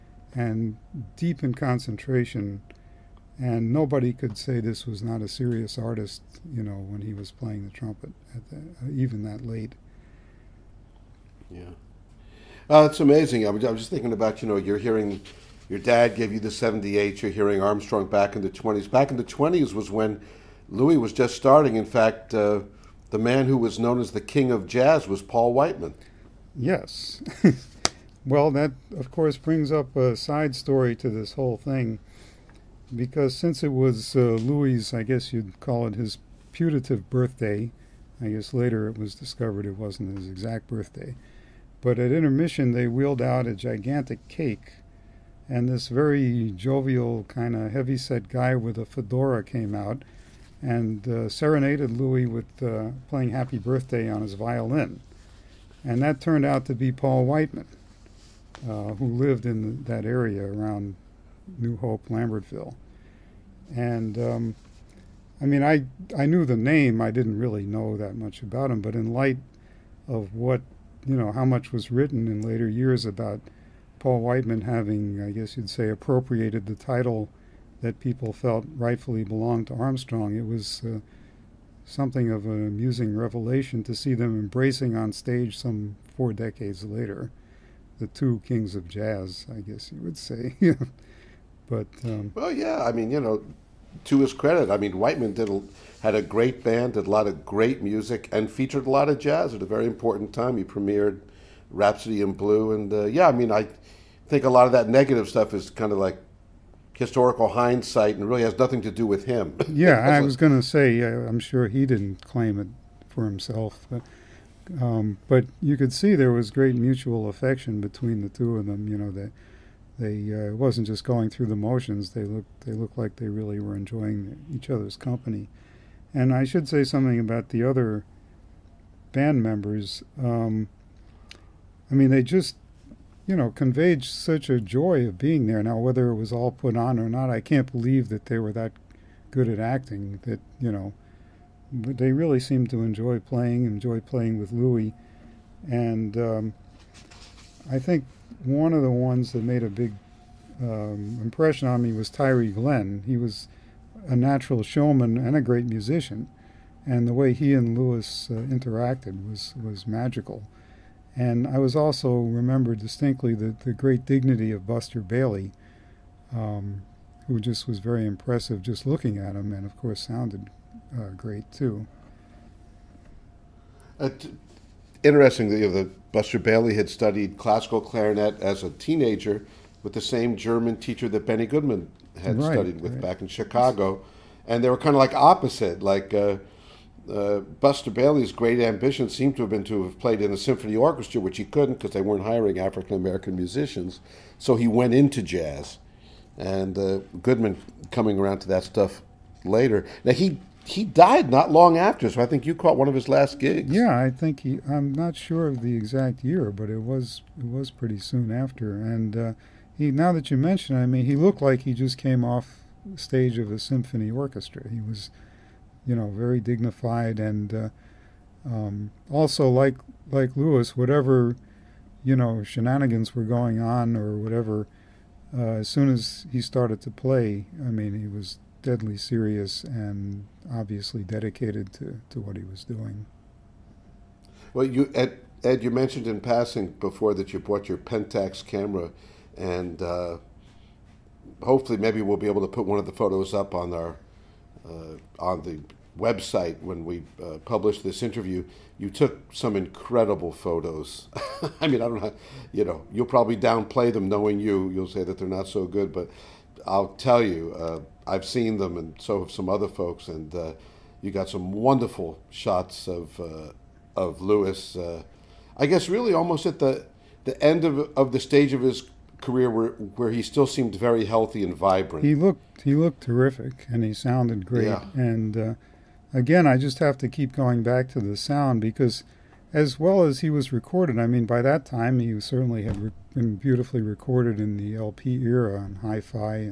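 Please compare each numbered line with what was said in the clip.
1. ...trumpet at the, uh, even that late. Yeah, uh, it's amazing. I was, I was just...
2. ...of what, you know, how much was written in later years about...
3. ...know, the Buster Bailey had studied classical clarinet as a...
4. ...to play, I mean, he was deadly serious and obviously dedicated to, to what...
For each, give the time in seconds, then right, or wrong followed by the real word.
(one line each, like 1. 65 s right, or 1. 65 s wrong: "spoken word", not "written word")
1. 7 s right
2. 70 s right
3. 175 s right
4. 226 s right.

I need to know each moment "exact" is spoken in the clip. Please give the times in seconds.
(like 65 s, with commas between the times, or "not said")
40 s, 205 s.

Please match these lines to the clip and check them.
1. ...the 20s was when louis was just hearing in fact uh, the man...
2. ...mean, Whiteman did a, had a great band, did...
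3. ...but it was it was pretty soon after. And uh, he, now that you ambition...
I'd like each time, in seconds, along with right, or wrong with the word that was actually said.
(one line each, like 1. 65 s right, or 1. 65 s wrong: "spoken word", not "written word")
1. 19 s wrong: "starting", not "hearing"
2. 94 s right
3. 206 s wrong: "mention", not "ambition".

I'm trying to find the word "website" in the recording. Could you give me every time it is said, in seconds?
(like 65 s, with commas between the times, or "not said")
245 s.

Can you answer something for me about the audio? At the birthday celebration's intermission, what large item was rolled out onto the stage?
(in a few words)
A gigantic cake.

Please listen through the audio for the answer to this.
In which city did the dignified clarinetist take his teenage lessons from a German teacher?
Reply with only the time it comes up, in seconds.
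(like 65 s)
183 s.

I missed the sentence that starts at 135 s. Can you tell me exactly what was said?
Now, whether it was all put on or not, I can't believe that they were that good at acting.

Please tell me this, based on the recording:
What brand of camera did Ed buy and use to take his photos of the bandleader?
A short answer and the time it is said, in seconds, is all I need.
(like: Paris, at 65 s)
Pentax, at 237 s.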